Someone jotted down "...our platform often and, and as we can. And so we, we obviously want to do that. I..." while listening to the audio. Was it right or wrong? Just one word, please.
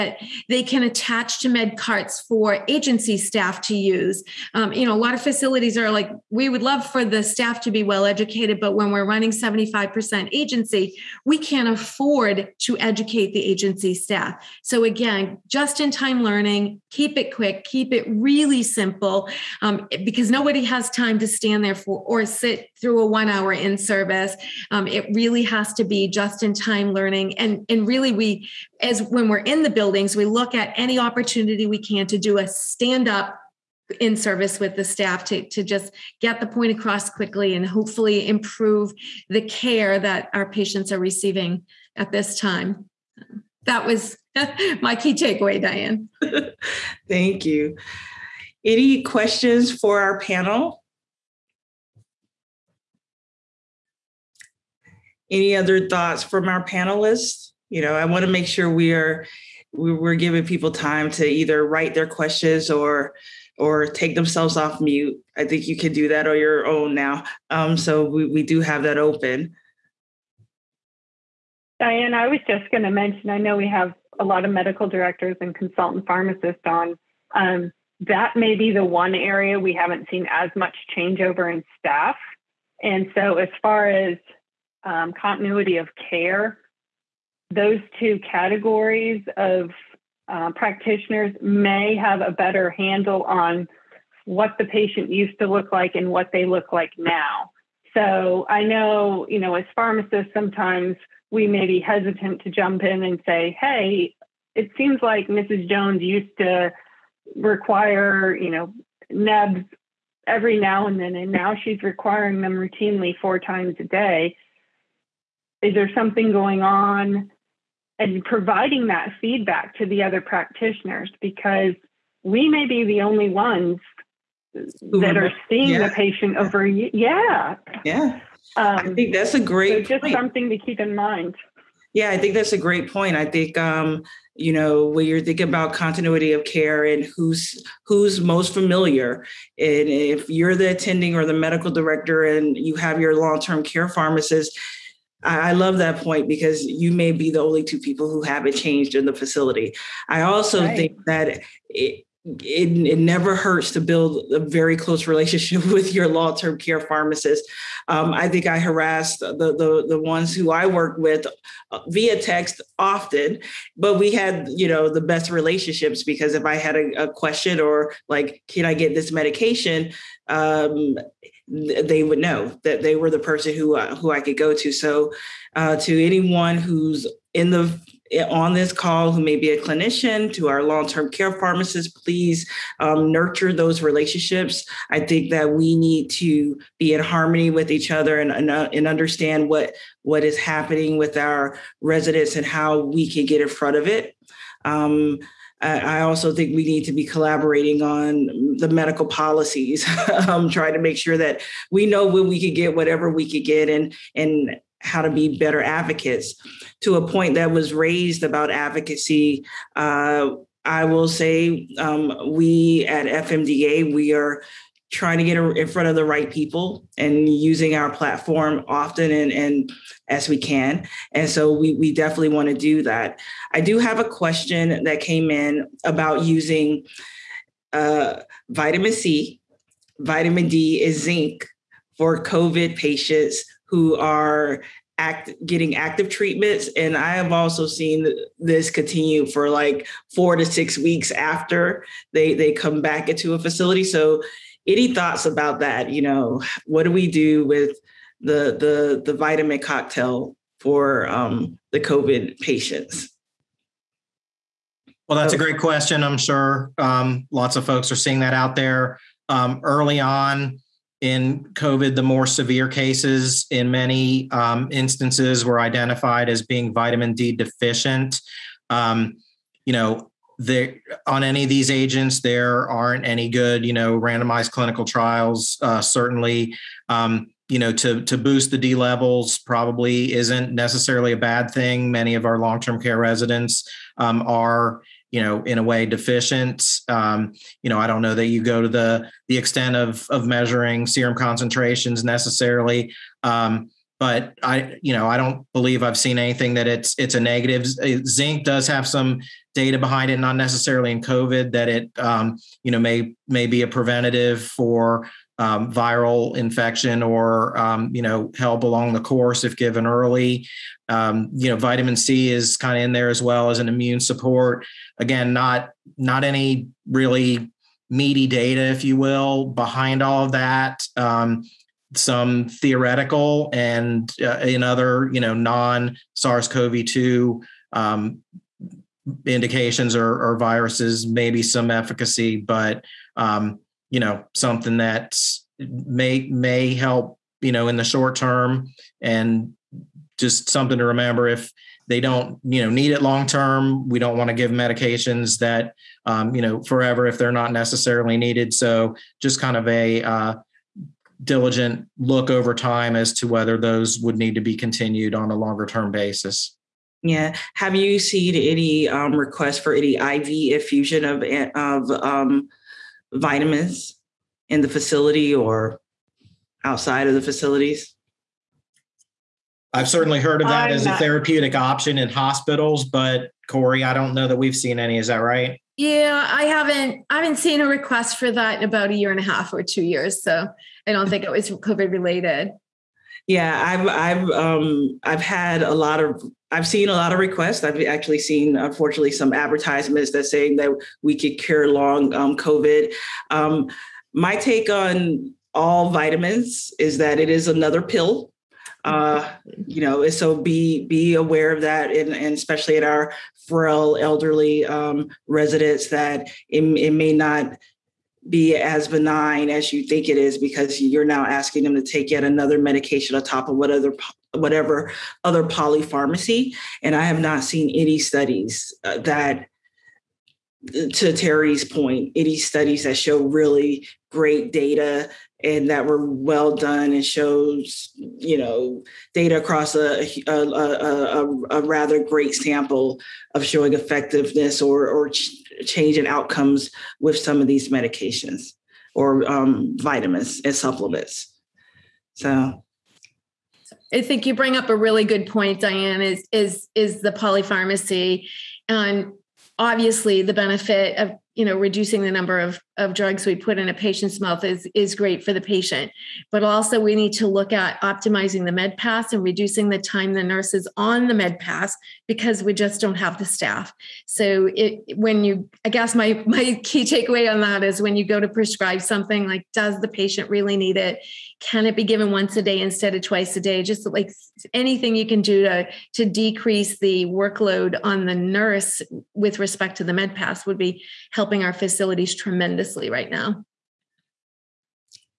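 wrong.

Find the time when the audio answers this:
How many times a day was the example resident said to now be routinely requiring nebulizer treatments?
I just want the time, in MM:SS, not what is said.
01:53.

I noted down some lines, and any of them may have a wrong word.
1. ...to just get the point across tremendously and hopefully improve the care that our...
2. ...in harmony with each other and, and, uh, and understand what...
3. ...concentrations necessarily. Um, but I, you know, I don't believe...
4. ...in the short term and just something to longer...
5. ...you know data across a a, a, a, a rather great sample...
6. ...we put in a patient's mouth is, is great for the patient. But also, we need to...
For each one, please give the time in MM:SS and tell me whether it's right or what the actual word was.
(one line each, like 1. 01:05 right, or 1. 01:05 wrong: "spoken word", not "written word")
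1. 00:35 wrong: "quickly", not "tremendously"
2. 03:06 right
3. 04:51 right
4. 05:37 wrong: "remember", not "longer"
5. 07:07 right
6. 07:33 right.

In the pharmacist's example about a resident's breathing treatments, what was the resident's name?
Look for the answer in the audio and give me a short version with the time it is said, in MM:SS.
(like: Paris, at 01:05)
Mrs. Jones, at 01:45.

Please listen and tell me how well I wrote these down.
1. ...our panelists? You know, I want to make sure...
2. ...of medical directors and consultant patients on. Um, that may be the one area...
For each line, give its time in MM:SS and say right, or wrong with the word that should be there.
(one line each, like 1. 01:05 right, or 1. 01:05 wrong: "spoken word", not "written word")
1. 00:56 right
2. 01:14 wrong: "pharmacists", not "patients".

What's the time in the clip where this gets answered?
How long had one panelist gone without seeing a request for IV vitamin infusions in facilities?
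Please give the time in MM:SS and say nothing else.
06:18.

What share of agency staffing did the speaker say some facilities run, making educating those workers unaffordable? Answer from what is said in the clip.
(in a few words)
75%.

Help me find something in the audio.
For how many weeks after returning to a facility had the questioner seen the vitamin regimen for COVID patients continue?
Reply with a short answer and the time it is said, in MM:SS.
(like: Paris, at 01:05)
4 to 6 weeks, at 04:00.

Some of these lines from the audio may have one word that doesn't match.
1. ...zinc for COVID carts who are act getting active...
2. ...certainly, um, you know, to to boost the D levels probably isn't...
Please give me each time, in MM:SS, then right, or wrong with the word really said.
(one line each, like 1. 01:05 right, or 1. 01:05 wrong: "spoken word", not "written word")
1. 03:51 wrong: "patients", not "carts"
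2. 04:35 right.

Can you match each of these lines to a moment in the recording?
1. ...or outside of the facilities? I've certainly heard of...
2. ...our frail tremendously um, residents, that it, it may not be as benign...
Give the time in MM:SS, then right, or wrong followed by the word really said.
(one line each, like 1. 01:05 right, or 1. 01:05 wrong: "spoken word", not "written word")
1. 06:05 right
2. 06:42 wrong: "elderly", not "tremendously".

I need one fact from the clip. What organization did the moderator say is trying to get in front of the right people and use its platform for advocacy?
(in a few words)
FMDA.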